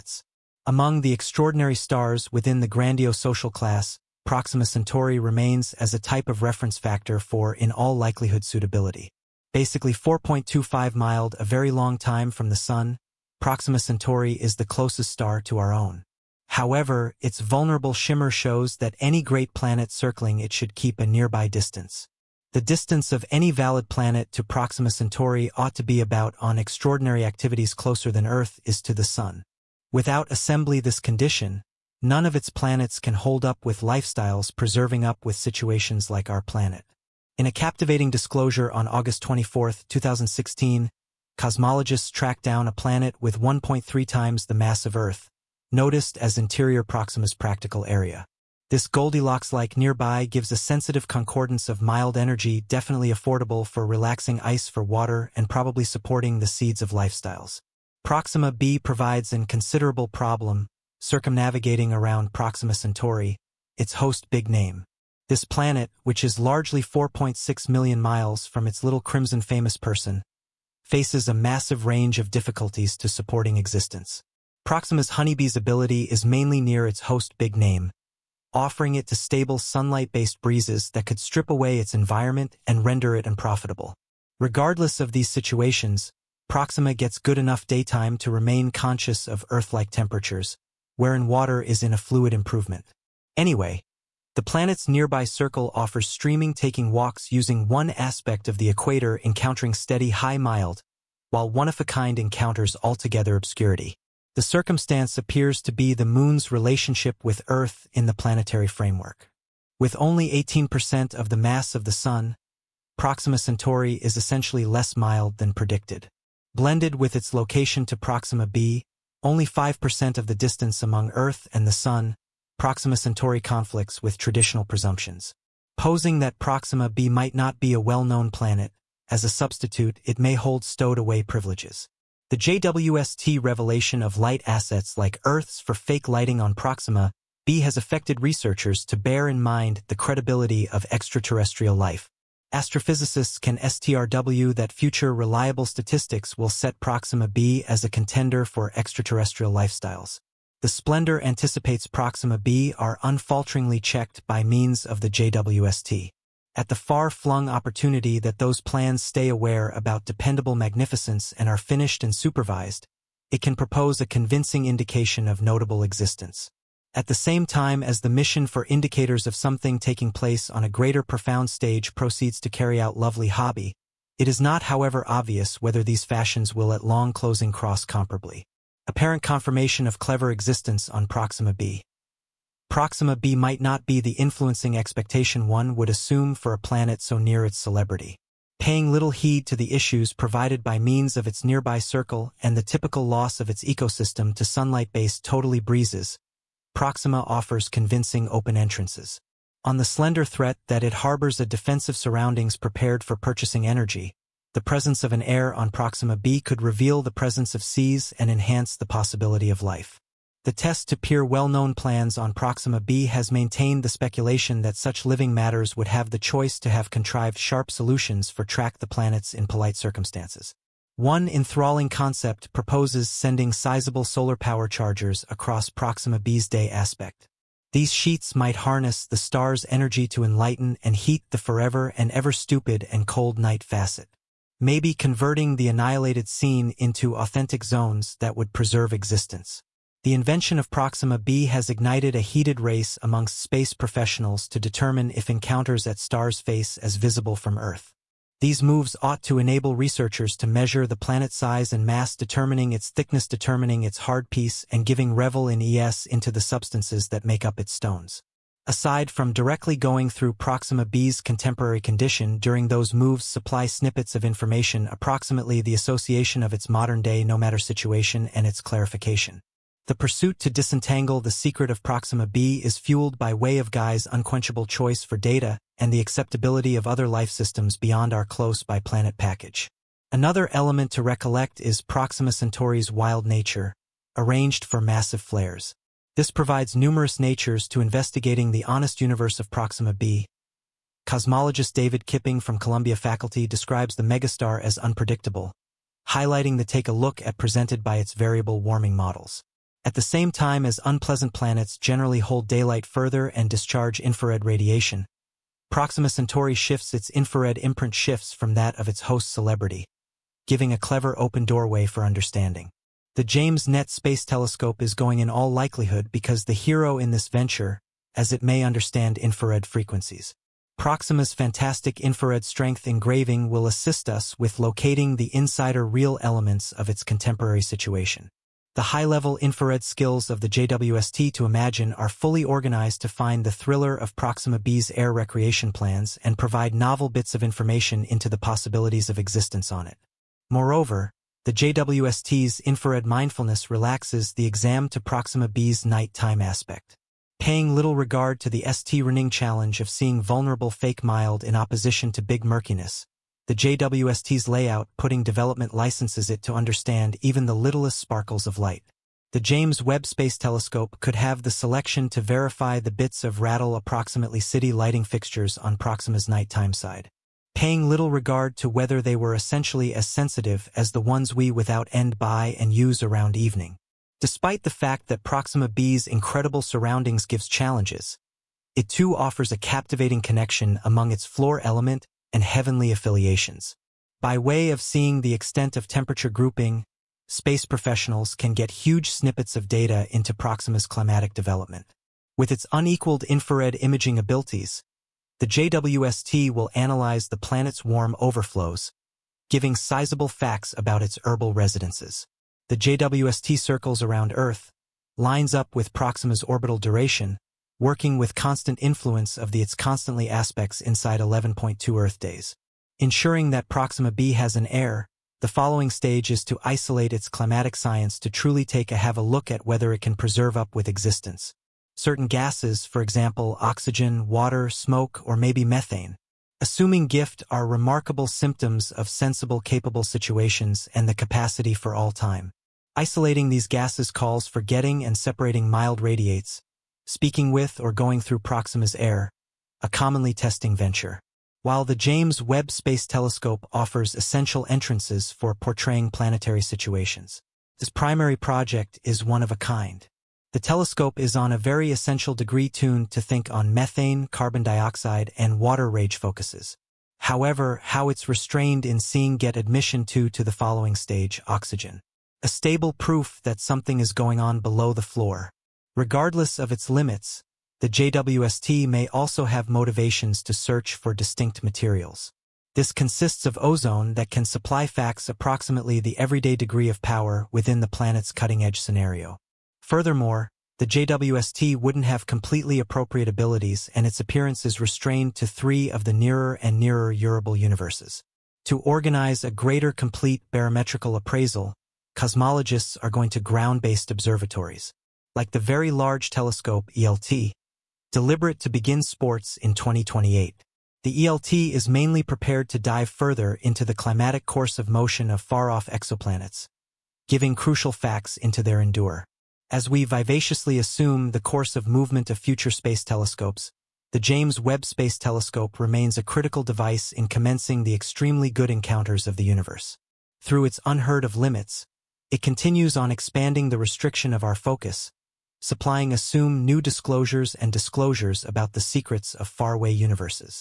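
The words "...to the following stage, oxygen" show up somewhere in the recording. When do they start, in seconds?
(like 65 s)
460 s.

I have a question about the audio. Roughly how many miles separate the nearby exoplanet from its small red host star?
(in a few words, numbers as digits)
4.6 million miles.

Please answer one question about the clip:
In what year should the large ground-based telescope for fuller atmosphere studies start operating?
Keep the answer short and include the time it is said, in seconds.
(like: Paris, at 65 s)
2028, at 499 s.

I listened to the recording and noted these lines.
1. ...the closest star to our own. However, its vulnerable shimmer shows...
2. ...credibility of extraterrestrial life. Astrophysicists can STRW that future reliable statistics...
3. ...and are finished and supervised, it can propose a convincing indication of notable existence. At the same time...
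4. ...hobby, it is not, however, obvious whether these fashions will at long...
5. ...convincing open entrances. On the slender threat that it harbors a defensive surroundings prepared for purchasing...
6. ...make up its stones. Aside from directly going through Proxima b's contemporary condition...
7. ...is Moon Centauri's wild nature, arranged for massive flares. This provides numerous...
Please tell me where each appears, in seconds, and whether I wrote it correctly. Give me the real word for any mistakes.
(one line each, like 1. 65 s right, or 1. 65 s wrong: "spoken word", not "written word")
1. 14 s right
2. 139 s right
3. 161 s right
4. 173 s right
5. 197 s right
6. 257 s right
7. 281 s wrong: "Proxima", not "Moon".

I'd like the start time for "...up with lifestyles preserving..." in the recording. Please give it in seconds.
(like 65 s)
33 s.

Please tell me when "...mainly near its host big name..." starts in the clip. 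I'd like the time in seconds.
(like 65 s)
76 s.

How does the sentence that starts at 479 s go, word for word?
Furthermore, the JWST wouldn't have completely appropriate abilities and its appearance is restrained to three of the nearer and nearer Eurable universes.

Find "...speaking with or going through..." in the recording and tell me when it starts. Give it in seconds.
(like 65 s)
437 s.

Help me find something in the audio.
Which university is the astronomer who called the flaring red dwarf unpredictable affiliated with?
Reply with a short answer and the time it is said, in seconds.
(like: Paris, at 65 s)
Columbia, at 292 s.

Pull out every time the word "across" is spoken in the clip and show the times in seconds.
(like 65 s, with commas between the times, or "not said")
225 s.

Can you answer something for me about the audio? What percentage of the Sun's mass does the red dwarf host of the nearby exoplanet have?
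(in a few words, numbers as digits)
18%.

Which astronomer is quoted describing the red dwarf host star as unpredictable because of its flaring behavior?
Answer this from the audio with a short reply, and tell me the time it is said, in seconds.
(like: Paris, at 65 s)
David Kipping, at 291 s.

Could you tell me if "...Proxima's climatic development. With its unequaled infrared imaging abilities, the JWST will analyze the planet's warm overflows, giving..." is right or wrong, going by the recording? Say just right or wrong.
right.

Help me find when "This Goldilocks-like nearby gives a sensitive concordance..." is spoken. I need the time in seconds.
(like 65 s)
48 s.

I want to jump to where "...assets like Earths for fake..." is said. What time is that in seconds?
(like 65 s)
134 s.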